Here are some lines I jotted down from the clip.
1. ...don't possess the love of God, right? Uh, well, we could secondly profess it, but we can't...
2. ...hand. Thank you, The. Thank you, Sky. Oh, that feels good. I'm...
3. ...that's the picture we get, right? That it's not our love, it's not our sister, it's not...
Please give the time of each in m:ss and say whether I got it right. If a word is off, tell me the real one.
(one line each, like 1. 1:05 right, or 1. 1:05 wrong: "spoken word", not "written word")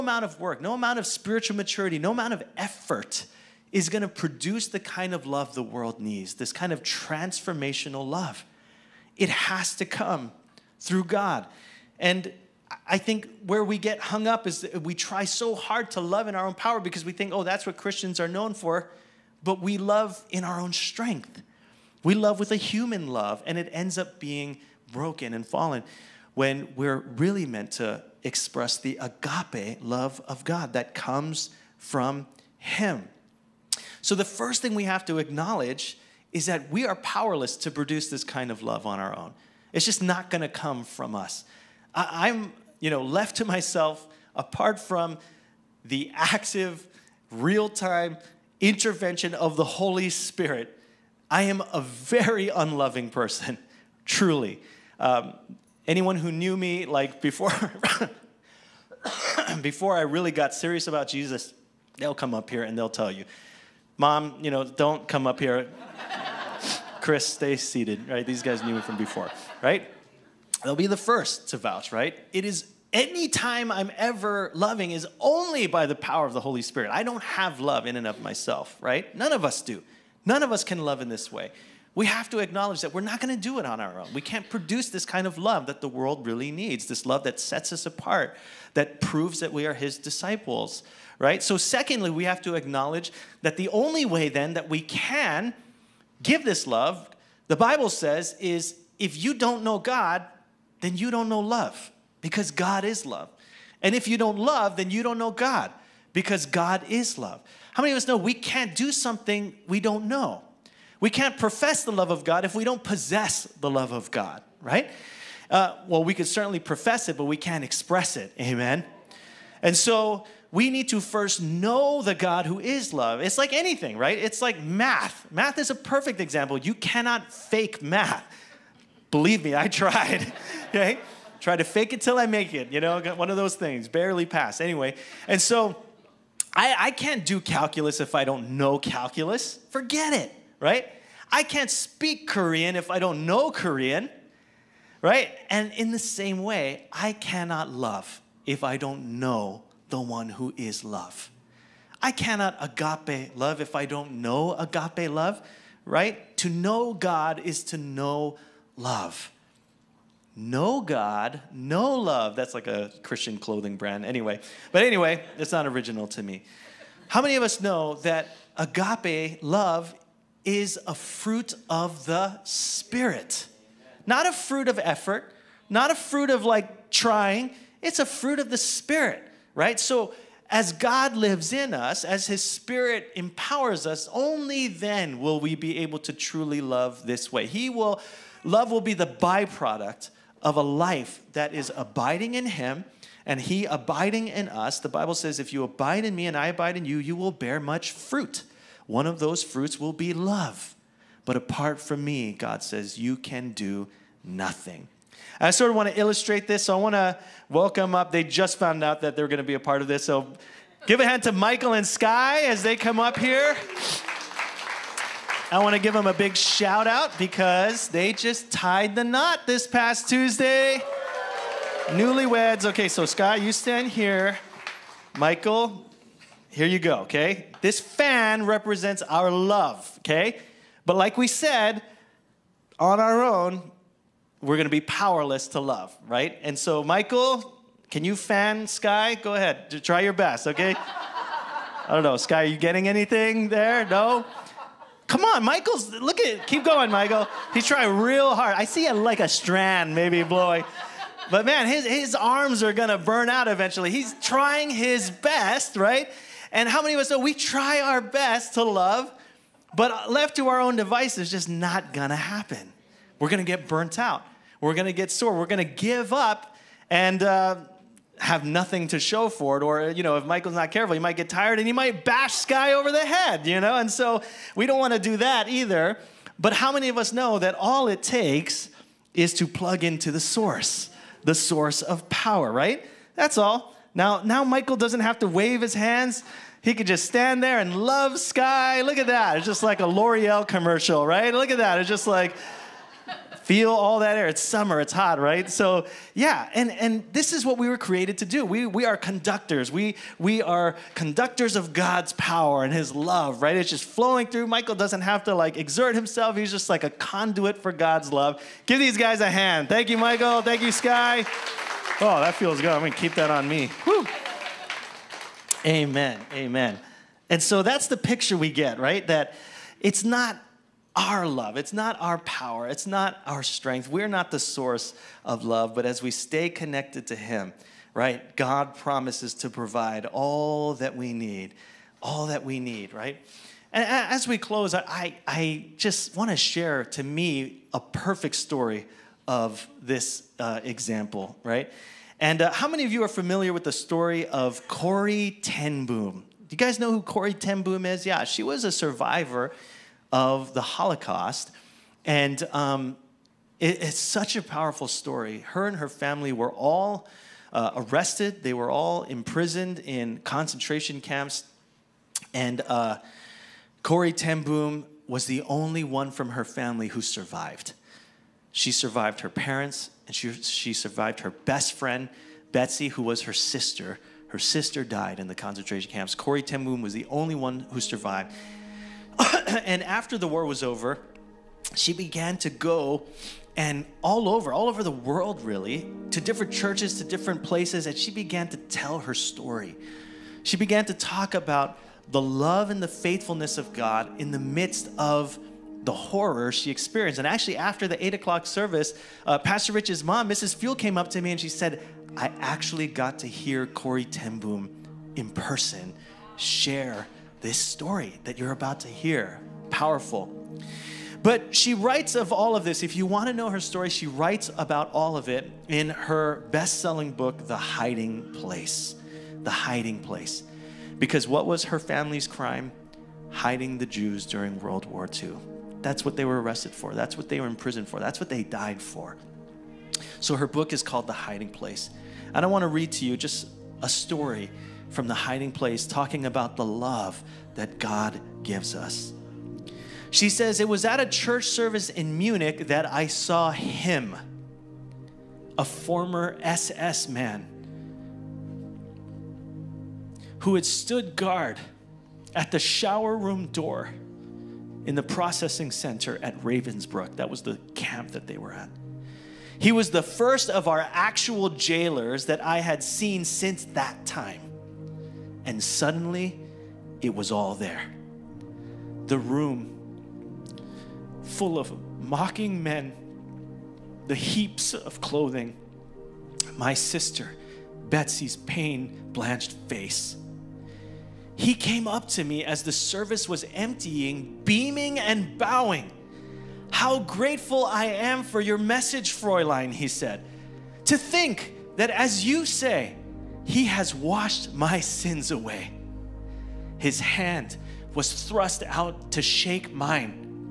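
1. 1:52 wrong: "certainly", not "secondly"
2. 5:09 wrong: "Michael", not "The"
3. 5:17 wrong: "power", not "sister".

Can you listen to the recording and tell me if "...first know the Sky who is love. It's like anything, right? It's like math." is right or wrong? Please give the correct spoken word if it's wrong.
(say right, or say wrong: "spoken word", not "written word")
wrong: "God", not "Sky".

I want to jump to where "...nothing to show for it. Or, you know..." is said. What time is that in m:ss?
4:28.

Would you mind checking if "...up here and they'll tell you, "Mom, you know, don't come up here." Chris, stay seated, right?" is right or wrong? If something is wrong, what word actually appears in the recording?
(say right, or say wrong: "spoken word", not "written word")
right.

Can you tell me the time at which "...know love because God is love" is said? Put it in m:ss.
1:41.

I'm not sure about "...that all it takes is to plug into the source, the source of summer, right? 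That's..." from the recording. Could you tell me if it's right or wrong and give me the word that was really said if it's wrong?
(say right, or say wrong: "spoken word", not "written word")
wrong: "power", not "summer".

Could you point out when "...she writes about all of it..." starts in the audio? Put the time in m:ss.
6:53.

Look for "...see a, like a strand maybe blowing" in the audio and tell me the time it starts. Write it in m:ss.
4:08.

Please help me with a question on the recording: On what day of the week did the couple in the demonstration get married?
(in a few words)
Tuesday.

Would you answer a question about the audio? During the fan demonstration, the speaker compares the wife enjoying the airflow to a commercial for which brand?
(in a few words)
L'Oreal.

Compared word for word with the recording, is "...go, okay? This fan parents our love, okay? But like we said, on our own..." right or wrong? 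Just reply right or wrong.
wrong.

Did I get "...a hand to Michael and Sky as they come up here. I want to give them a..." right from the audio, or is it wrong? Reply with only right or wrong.
right.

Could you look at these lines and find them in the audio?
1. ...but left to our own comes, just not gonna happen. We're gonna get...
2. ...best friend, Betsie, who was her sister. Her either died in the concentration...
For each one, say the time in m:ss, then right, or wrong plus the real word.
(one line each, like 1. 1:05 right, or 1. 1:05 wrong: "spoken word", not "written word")
1. 4:19 wrong: "devices", not "comes"
2. 6:11 wrong: "sister", not "either".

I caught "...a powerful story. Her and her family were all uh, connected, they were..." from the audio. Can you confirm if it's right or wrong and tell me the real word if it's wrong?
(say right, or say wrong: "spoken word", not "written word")
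wrong: "arrested", not "connected".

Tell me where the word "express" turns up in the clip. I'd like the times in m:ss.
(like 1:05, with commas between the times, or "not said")
0:28, 1:57.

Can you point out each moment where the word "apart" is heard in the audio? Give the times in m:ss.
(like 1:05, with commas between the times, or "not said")
0:44, 1:27, 3:21.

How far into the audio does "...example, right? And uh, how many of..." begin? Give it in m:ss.
5:40.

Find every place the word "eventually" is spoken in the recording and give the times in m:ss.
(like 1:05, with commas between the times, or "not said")
4:13.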